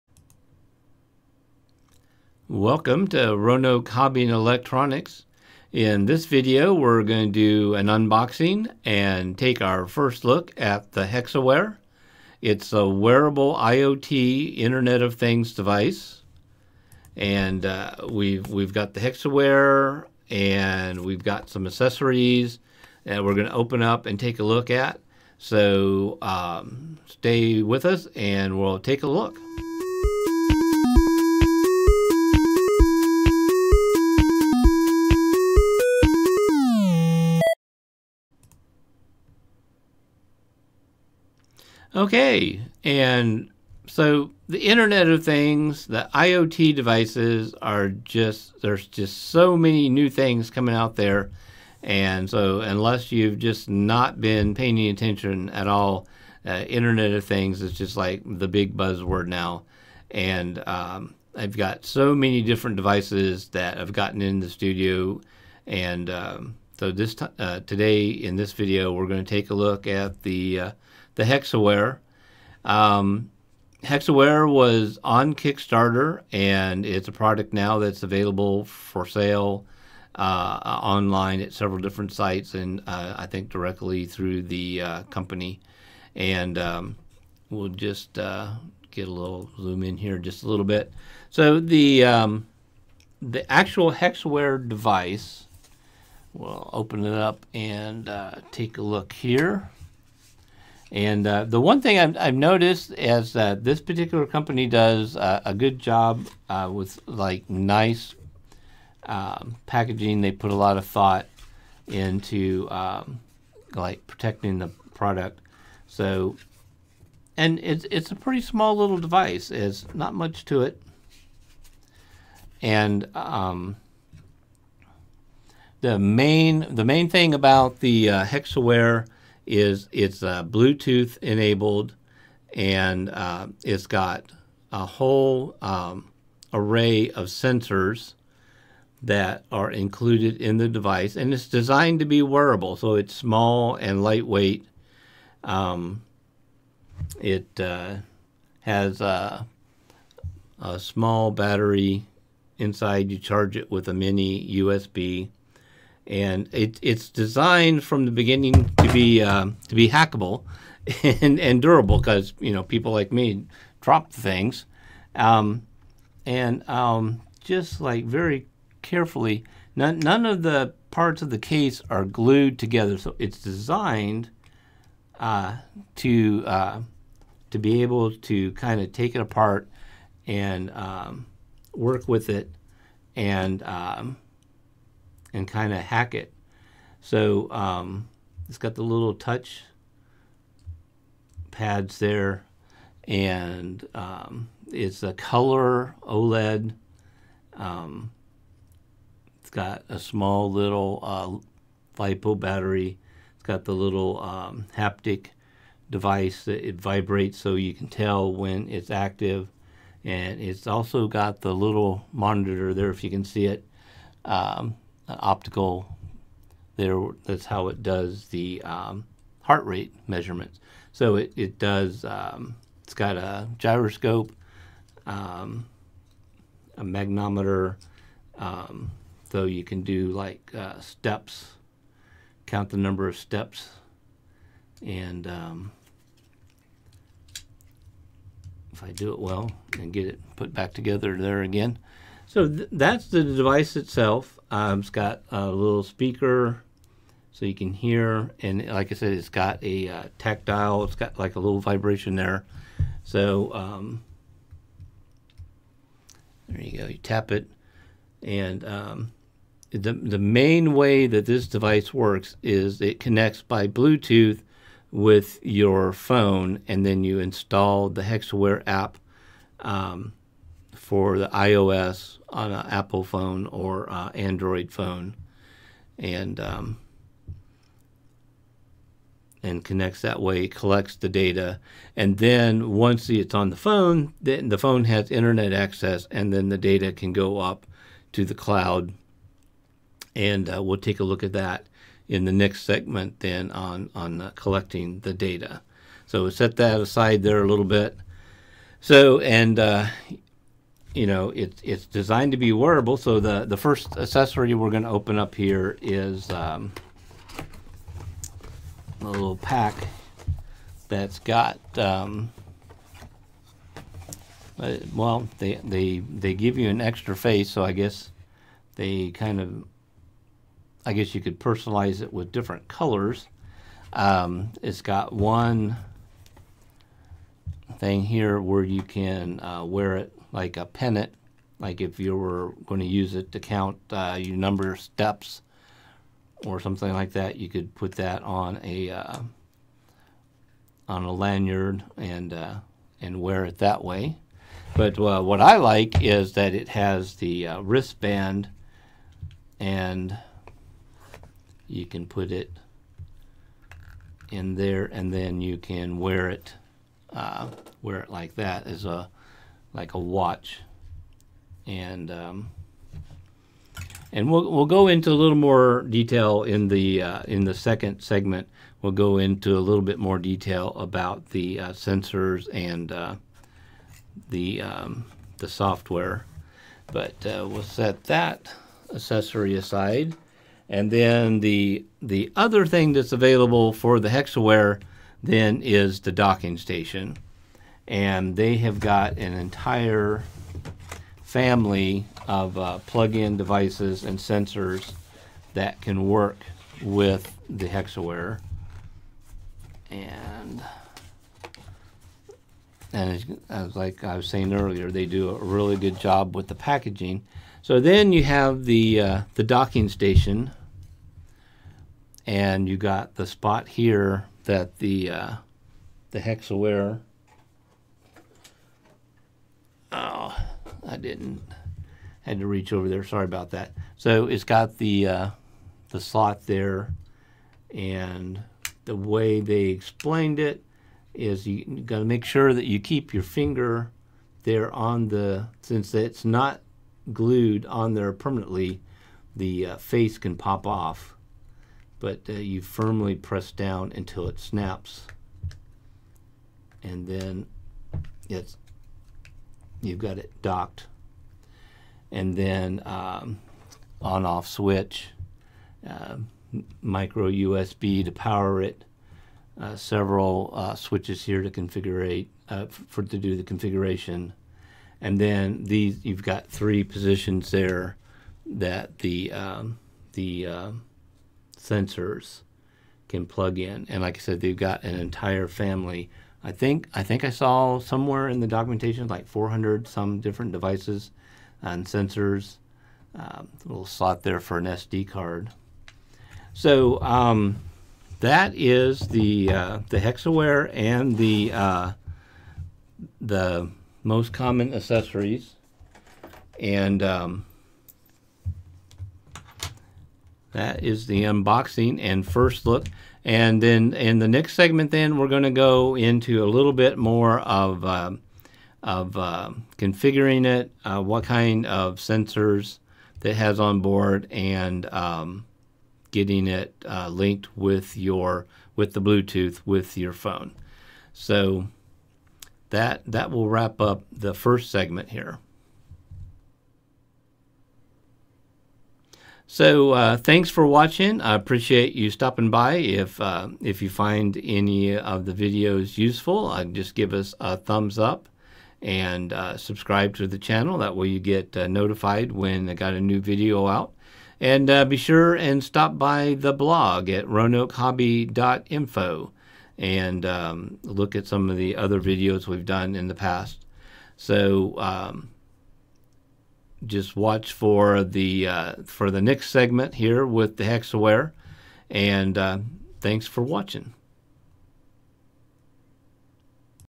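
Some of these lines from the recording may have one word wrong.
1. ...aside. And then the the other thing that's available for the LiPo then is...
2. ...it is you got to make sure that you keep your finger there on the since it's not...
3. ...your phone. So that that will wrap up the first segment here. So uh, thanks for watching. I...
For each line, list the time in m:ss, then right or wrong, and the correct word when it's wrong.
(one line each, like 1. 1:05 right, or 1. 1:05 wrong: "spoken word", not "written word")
1. 6:19 wrong: "Hexiwear", not "LiPo"
2. 7:10 right
3. 8:39 right.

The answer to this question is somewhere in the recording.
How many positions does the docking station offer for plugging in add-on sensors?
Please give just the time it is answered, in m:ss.
7:46.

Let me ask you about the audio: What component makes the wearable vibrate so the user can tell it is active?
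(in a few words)
haptic device.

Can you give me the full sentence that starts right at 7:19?
The uh, face can pop off, but uh, you firmly press down until it snaps, and then it's you've got it docked.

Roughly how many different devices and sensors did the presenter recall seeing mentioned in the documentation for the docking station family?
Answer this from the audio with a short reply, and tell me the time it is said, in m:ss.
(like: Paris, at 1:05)
400, at 7:59.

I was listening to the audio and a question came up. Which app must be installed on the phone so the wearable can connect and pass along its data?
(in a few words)
Hexiwear app.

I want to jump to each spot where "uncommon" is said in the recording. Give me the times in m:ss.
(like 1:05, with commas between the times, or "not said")
not said.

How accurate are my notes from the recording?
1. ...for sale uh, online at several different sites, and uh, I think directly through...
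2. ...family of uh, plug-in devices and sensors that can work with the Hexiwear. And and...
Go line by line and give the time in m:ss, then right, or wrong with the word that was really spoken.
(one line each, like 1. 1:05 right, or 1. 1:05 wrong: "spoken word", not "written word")
1. 1:18 right
2. 6:31 right.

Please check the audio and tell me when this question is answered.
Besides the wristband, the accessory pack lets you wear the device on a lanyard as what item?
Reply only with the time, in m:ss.
5:30.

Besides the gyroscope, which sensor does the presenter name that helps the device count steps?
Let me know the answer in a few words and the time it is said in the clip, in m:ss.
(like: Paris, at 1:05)
magnometer, at 3:46.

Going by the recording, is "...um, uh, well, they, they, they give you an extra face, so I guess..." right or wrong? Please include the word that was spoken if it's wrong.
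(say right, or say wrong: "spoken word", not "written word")
right.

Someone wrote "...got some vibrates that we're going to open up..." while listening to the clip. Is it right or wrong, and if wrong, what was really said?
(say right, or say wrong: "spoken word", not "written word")
wrong: "accessories", not "vibrates".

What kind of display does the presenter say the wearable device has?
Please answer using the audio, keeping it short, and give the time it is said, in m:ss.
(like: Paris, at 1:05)
color OLED, at 3:15.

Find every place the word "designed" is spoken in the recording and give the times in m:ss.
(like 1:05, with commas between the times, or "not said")
2:21, 2:37, 2:53, 5:01.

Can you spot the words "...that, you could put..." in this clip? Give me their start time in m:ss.
5:37.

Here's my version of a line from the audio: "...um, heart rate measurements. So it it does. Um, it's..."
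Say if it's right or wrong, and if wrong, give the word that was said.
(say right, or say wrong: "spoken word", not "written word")
right.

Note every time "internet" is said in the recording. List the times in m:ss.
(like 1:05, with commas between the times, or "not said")
0:14, 0:44, 0:56, 4:45.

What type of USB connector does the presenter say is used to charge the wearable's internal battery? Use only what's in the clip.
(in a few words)
mini USB.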